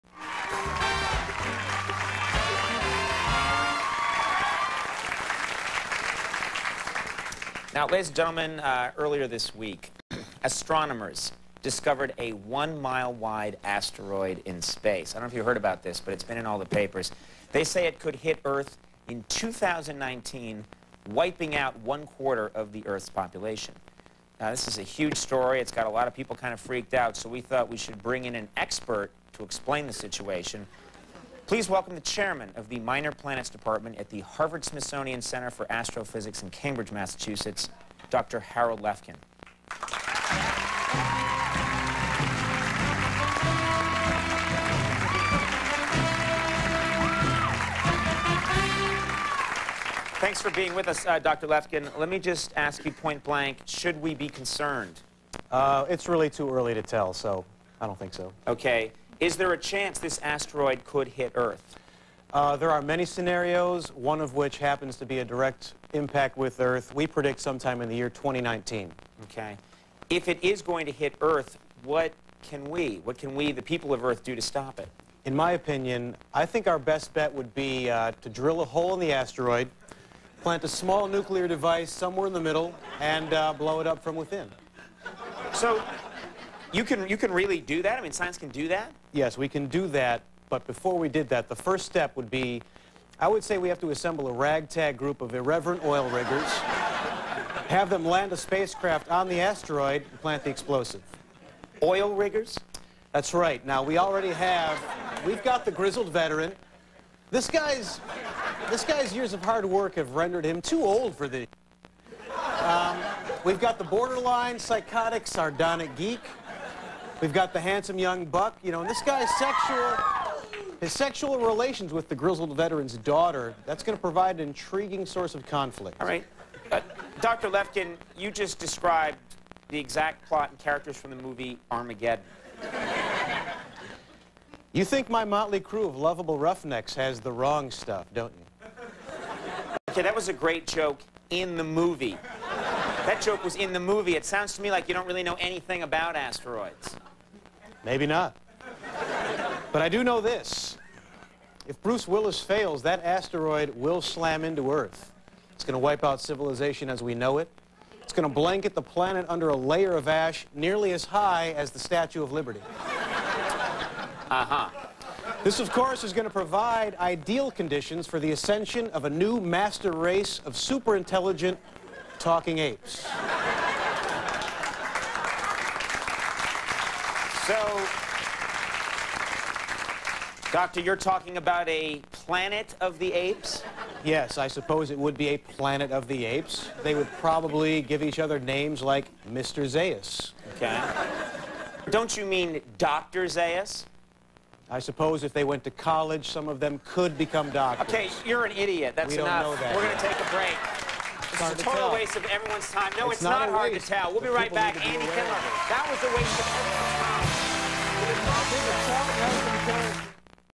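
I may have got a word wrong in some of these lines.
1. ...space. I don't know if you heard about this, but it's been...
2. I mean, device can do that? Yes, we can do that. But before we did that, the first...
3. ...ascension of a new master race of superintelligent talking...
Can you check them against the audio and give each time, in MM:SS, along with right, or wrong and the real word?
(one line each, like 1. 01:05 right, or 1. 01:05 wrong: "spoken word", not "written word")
1. 00:14 right
2. 01:27 wrong: "science", not "device"
3. 02:48 right.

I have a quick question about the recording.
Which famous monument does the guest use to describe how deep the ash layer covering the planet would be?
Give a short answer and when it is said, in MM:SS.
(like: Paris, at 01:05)
Statue of Liberty, at 02:41.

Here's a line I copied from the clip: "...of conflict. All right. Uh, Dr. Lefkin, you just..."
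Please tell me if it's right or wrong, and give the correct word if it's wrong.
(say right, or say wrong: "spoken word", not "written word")
right.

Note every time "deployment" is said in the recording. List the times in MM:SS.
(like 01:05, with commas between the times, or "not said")
not said.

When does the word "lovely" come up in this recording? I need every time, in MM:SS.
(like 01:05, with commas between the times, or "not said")
not said.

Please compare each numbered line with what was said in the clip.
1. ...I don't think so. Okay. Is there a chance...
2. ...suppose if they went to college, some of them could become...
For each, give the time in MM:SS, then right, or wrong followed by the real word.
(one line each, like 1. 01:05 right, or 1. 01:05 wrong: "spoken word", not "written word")
1. 00:57 right
2. 03:14 right.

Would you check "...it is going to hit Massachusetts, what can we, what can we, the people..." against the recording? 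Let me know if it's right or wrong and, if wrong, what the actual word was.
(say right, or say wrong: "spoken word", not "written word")
wrong: "Earth", not "Massachusetts".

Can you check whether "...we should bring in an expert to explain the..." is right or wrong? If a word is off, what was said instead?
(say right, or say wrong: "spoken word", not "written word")
right.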